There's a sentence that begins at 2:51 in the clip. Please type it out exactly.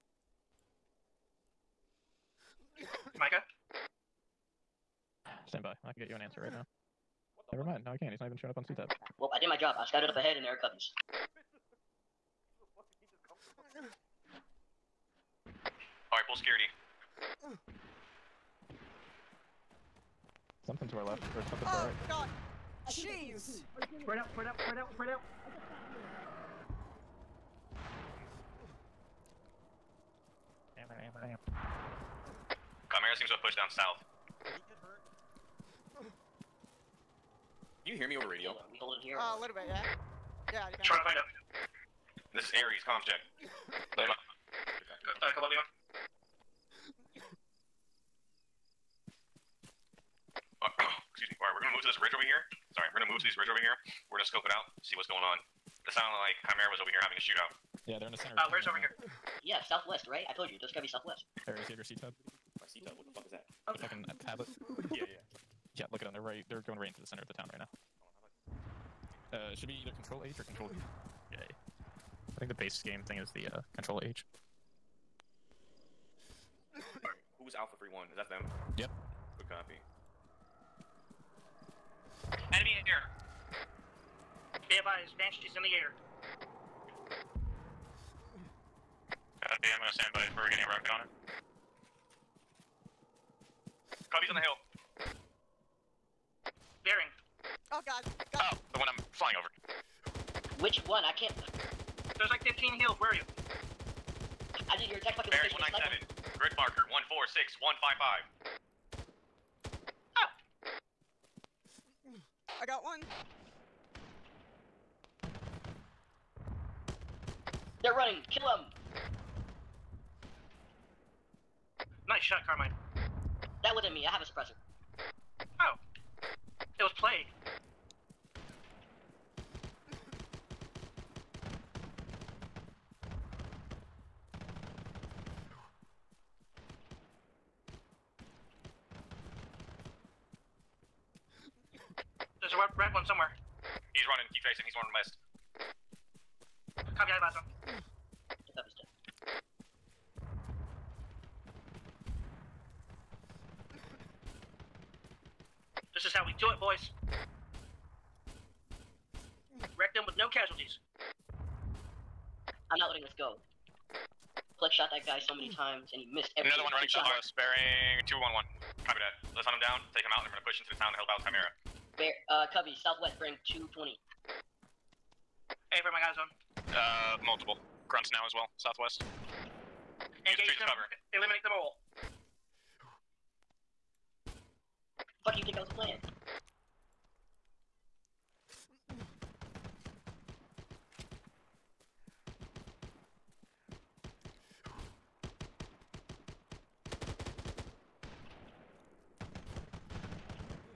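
Bear, uh, Covey, southwest, bearing 220.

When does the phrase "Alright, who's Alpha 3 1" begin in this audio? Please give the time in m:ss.
1:16.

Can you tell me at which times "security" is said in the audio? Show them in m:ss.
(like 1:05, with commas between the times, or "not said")
0:16.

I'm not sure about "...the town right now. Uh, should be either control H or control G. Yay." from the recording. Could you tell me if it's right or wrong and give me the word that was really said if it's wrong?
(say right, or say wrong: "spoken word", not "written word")
right.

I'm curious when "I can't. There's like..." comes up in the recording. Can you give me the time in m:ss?
1:41.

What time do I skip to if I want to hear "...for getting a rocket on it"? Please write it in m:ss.
1:30.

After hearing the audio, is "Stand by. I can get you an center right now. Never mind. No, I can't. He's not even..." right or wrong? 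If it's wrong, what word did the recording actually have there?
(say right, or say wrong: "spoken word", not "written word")
wrong: "answer", not "center".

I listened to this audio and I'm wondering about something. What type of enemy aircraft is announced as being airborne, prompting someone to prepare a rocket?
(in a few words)
Banshee.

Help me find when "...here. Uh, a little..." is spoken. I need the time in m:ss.
0:39.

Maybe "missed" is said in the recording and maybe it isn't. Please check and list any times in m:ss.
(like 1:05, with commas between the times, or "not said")
2:46.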